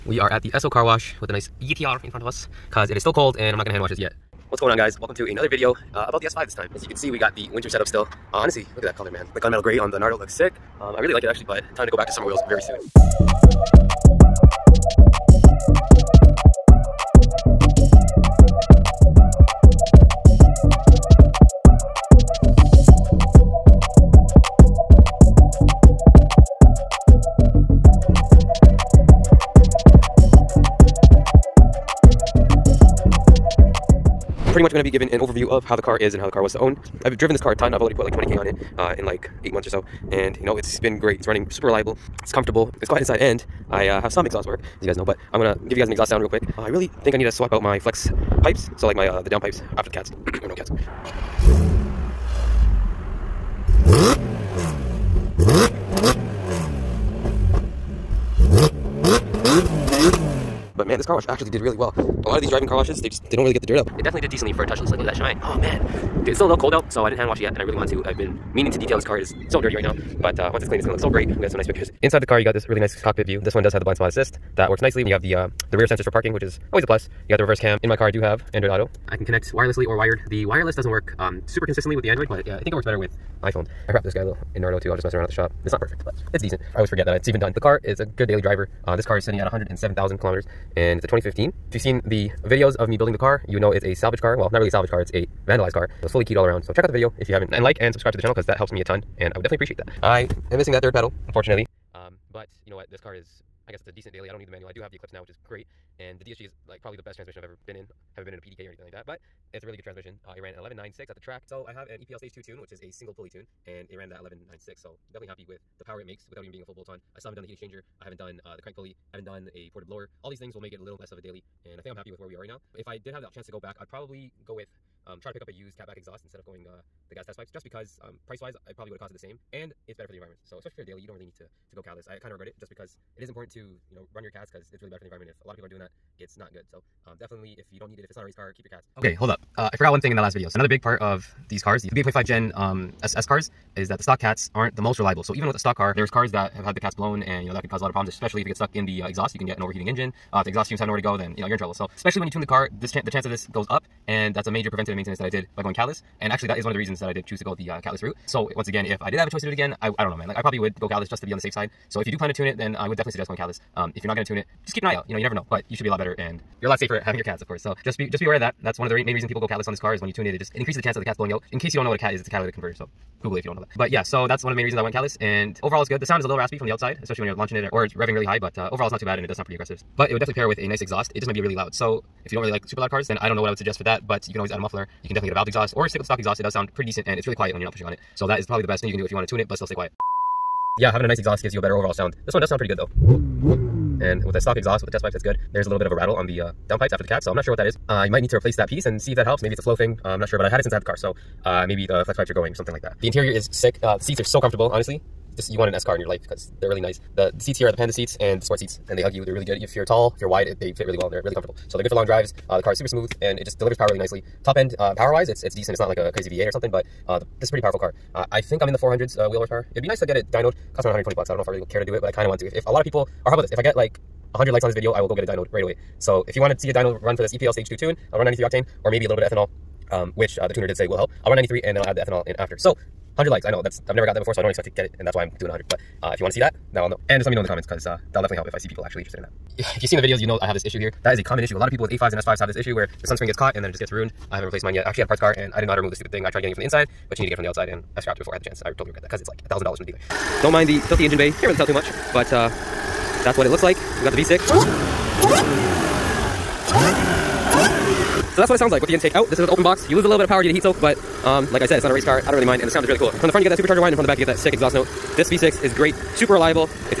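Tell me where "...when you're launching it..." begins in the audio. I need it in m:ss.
2:57.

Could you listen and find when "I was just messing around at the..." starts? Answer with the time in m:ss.
1:24.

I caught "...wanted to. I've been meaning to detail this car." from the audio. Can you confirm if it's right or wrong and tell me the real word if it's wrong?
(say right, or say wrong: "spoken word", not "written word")
right.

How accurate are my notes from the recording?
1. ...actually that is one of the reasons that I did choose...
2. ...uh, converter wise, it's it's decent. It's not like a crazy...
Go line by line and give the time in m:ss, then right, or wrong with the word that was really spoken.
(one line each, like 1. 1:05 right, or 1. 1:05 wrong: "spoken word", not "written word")
1. 2:36 right
2. 3:34 wrong: "power", not "converter".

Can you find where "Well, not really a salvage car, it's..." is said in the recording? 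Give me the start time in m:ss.
1:34.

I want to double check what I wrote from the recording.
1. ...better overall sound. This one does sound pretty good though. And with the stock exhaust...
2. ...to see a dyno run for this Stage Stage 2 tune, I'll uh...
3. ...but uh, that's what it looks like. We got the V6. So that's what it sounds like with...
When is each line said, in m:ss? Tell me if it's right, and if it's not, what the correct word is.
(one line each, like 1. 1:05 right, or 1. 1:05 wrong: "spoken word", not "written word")
1. 3:11 right
2. 3:46 wrong: "EPL", not "Stage"
3. 4:12 right.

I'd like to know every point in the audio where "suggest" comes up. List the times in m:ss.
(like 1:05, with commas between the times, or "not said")
2:43, 3:03.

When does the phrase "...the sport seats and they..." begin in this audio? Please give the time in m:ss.
3:28.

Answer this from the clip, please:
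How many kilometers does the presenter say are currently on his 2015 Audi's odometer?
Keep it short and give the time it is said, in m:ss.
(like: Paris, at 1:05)
107,000, at 1:29.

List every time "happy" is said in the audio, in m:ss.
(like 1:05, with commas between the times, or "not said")
1:55, 2:01.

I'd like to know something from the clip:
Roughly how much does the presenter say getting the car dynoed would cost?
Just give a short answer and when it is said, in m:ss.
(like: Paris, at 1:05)
120 bucks, at 3:40.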